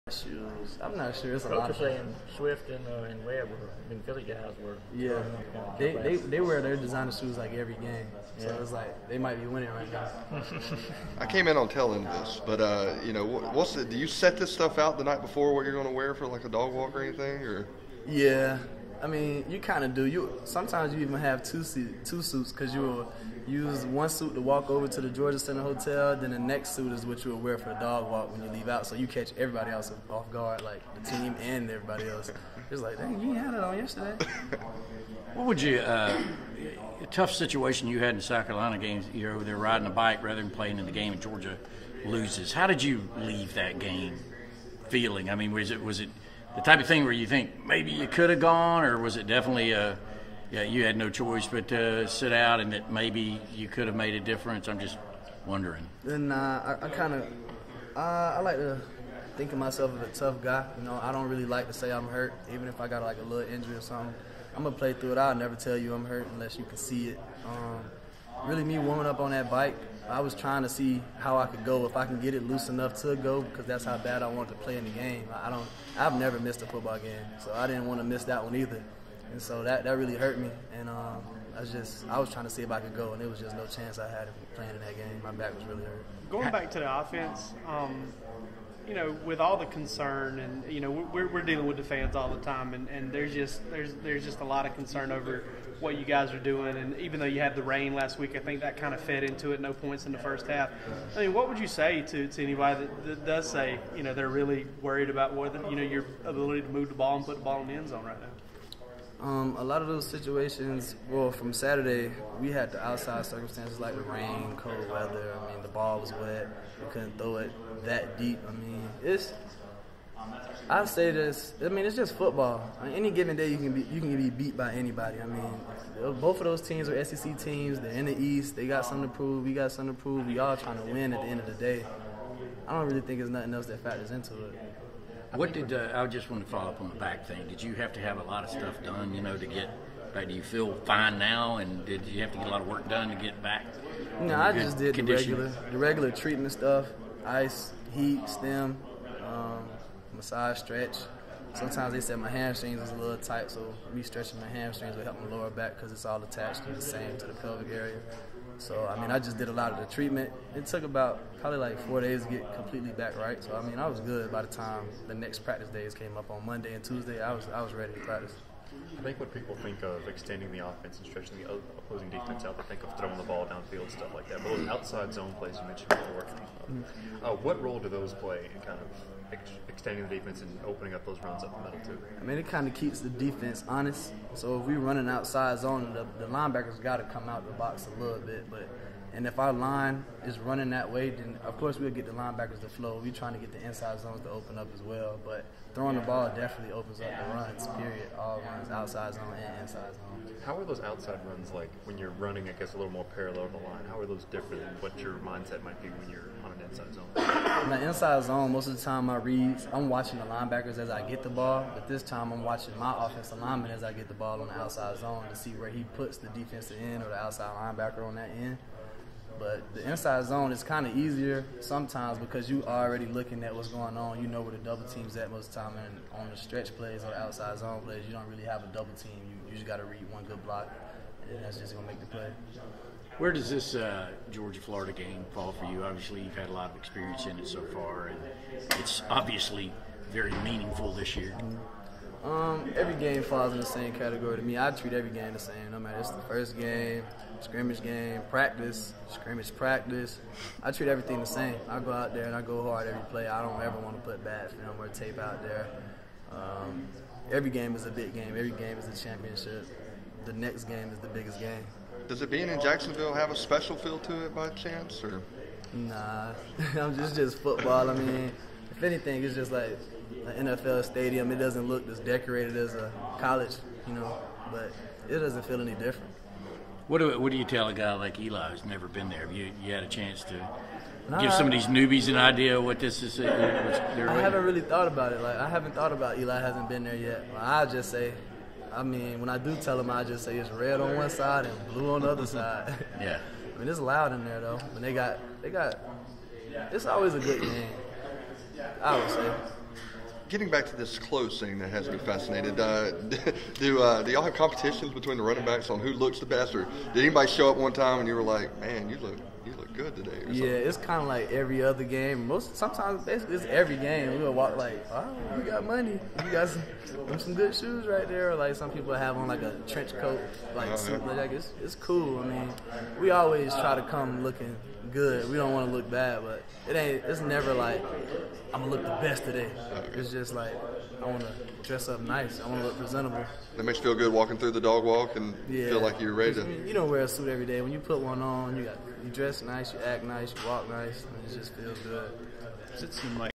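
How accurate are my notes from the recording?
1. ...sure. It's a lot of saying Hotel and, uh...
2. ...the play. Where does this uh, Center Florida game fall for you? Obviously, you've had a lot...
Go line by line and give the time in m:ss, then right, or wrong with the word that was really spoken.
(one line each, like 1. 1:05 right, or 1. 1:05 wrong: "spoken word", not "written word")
1. 0:01 wrong: "Swift", not "Hotel"
2. 3:51 wrong: "Georgia", not "Center".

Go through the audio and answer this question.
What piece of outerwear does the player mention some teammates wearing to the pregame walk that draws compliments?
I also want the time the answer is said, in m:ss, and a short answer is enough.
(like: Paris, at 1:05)
Trench coat, at 5:19.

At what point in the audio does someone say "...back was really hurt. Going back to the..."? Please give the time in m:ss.
1:25.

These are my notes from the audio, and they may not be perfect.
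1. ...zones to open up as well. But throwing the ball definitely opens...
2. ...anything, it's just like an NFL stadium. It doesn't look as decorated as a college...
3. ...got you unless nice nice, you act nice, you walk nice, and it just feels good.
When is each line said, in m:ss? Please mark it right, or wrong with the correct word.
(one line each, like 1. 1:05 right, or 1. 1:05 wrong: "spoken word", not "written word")
1. 3:13 right
2. 4:28 right
3. 5:38 wrong: "dress", not "unless".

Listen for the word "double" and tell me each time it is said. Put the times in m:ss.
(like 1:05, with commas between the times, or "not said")
3:44, 3:48.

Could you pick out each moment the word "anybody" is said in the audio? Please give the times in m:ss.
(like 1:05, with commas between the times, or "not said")
1:42, 2:04, 5:07.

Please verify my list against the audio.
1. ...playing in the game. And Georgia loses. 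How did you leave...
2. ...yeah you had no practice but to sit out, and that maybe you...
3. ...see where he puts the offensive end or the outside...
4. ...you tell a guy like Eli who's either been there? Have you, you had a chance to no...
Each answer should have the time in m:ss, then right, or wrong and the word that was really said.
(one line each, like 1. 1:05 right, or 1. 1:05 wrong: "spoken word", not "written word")
1. 0:40 right
2. 0:50 wrong: "choice", not "practice"
3. 3:35 wrong: "defensive", not "offensive"
4. 4:37 wrong: "never", not "either".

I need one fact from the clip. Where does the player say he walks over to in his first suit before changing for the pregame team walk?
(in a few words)
Georgia Center Hotel.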